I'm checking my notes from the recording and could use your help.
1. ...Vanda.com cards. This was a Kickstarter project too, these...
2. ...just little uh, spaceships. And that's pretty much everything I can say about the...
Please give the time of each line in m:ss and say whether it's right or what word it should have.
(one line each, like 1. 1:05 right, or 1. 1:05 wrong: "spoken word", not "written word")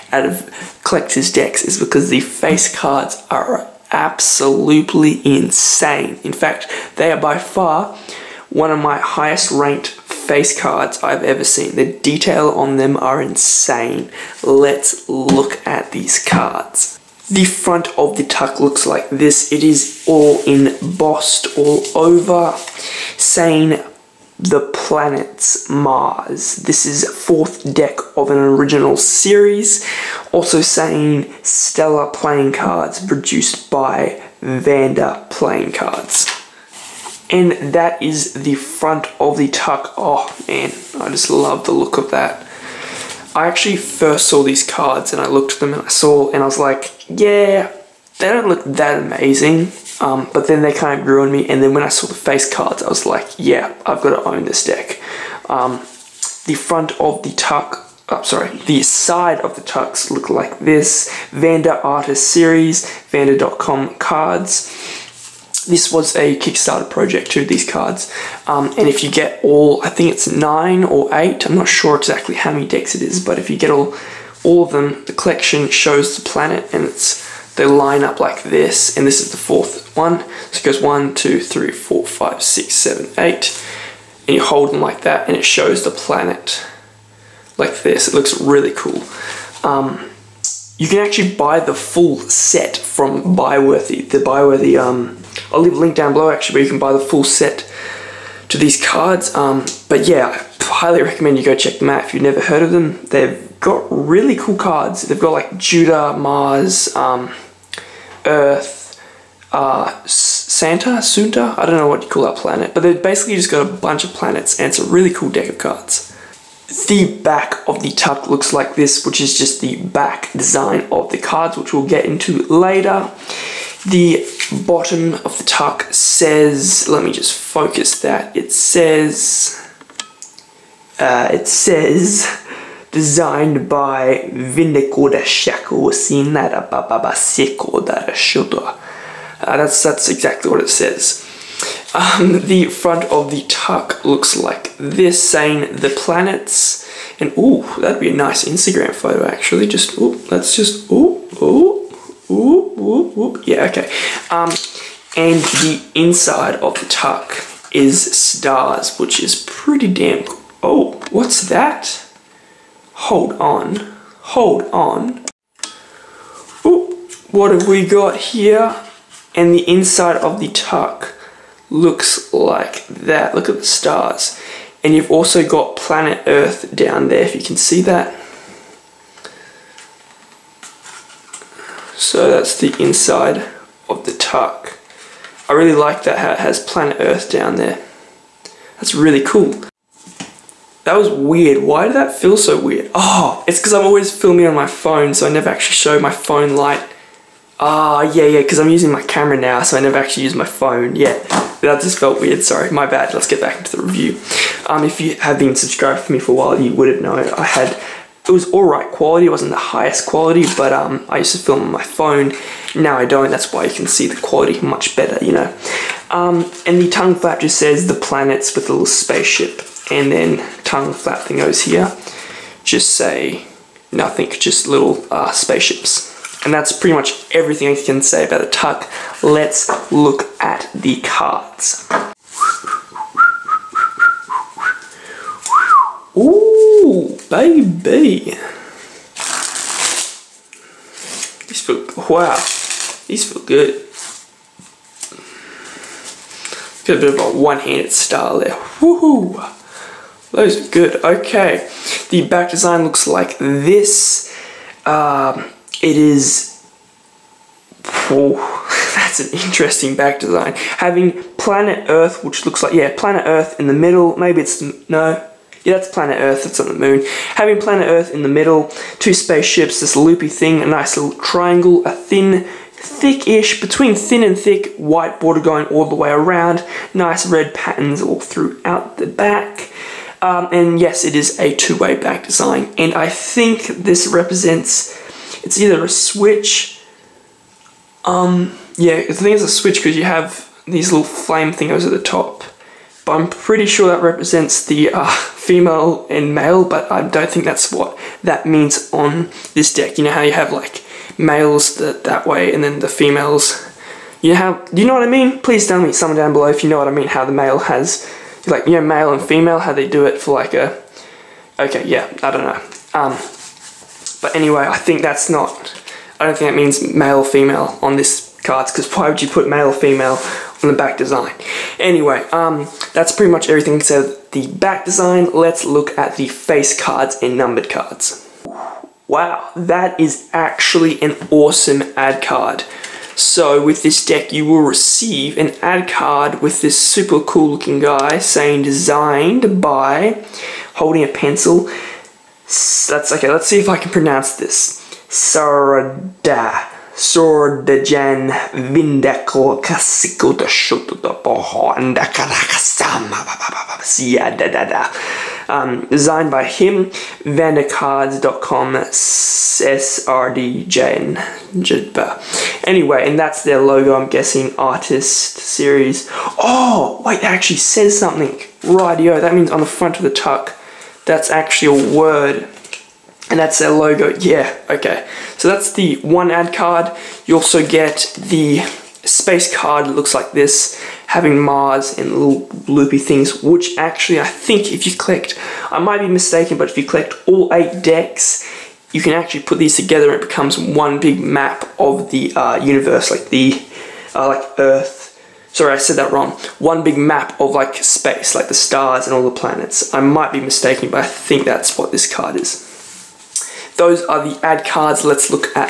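1. 1:03 right
2. 3:44 right.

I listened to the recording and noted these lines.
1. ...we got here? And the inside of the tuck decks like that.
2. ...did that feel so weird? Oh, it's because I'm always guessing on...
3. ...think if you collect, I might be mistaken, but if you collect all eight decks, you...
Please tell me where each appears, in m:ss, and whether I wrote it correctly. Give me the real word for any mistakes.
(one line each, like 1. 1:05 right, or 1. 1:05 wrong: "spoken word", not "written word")
1. 2:47 wrong: "looks", not "decks"
2. 3:11 wrong: "filming", not "guessing"
3. 6:24 right.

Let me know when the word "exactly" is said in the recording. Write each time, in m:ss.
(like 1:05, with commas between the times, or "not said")
1:11, 2:20.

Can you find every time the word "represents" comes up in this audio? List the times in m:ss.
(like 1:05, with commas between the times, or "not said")
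4:44, 4:54.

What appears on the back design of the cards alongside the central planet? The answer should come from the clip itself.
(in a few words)
Two spaceships.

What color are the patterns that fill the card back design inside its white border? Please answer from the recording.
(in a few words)
red.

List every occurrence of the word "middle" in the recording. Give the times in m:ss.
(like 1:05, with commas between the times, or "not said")
4:23, 4:28.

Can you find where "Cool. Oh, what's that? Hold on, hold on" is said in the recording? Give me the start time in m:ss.
2:40.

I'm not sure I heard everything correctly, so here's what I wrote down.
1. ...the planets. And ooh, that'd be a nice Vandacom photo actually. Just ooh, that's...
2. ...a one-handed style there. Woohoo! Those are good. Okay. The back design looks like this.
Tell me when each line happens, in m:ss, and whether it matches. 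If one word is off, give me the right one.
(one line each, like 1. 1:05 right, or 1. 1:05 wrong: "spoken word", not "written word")
1. 2:25 wrong: "Instagram", not "Vandacom"
2. 4:07 right.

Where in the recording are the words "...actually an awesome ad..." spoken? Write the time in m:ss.
5:30.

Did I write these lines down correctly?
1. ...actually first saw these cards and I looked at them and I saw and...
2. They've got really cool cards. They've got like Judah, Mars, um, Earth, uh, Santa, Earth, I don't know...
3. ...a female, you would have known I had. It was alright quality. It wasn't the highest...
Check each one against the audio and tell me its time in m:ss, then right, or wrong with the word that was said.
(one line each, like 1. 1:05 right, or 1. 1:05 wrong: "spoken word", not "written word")
1. 0:43 right
2. 1:43 wrong: "Sunta", not "Earth"
3. 3:26 wrong: "while", not "female".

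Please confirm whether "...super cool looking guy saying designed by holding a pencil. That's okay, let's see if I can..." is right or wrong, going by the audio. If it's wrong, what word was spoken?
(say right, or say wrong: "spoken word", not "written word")
right.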